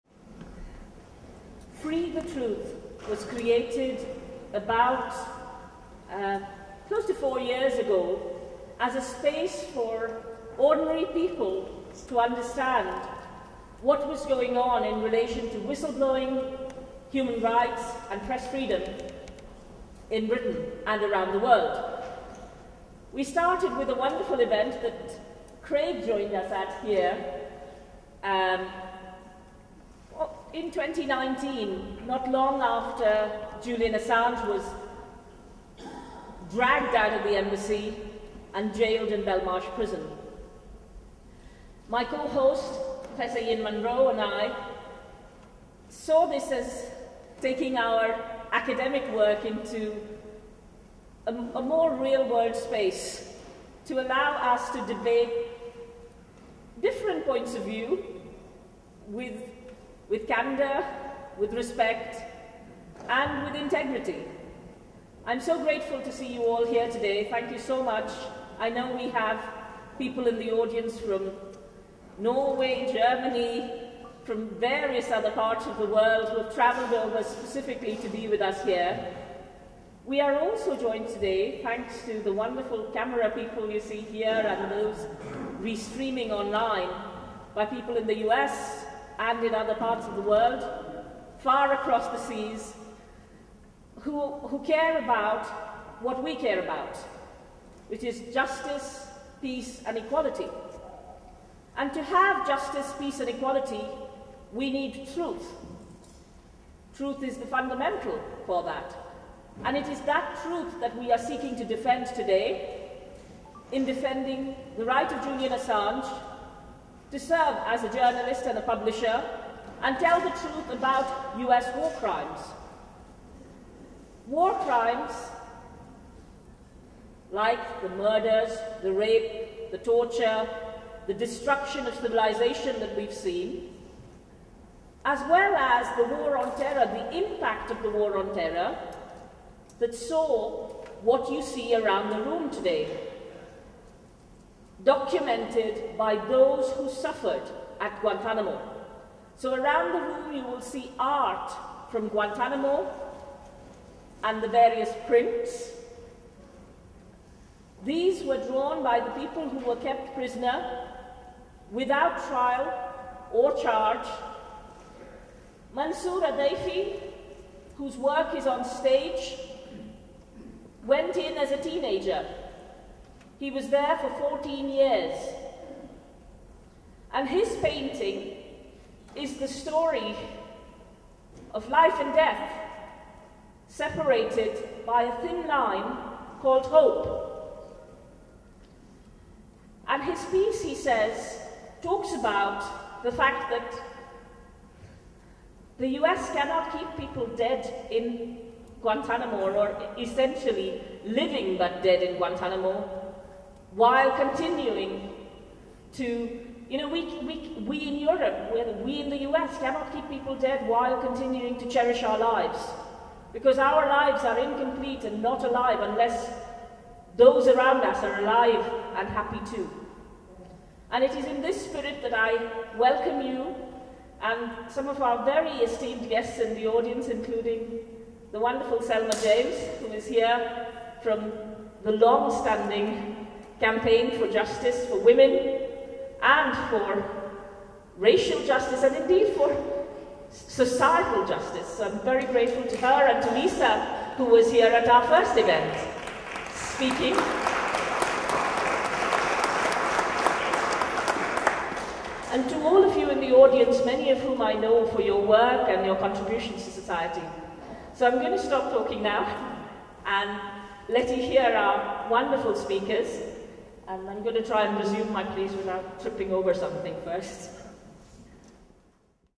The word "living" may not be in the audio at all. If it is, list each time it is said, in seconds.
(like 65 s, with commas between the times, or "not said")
201 s.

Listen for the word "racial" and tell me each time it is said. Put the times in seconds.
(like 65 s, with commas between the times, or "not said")
237 s.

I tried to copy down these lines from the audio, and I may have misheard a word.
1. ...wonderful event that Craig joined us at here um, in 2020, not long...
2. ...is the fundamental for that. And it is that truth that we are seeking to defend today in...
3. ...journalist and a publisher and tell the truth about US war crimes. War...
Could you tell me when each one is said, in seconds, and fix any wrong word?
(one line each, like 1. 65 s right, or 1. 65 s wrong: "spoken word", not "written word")
1. 23 s wrong: "2019", not "2020"
2. 107 s right
3. 117 s right.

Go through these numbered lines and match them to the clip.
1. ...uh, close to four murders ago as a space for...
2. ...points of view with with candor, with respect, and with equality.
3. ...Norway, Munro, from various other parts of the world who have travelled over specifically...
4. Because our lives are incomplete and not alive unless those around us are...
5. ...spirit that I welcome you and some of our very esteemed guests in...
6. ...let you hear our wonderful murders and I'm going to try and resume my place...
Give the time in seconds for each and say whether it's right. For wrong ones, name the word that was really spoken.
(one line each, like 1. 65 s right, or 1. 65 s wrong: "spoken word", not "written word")
1. 6 s wrong: "years", not "murders"
2. 57 s wrong: "integrity", not "equality"
3. 72 s wrong: "Germany", not "Munro"
4. 213 s right
5. 221 s right
6. 260 s wrong: "speakers", not "murders".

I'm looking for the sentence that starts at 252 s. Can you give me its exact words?
And to all of you in the audience, many of whom I know for your work and your contributions to society.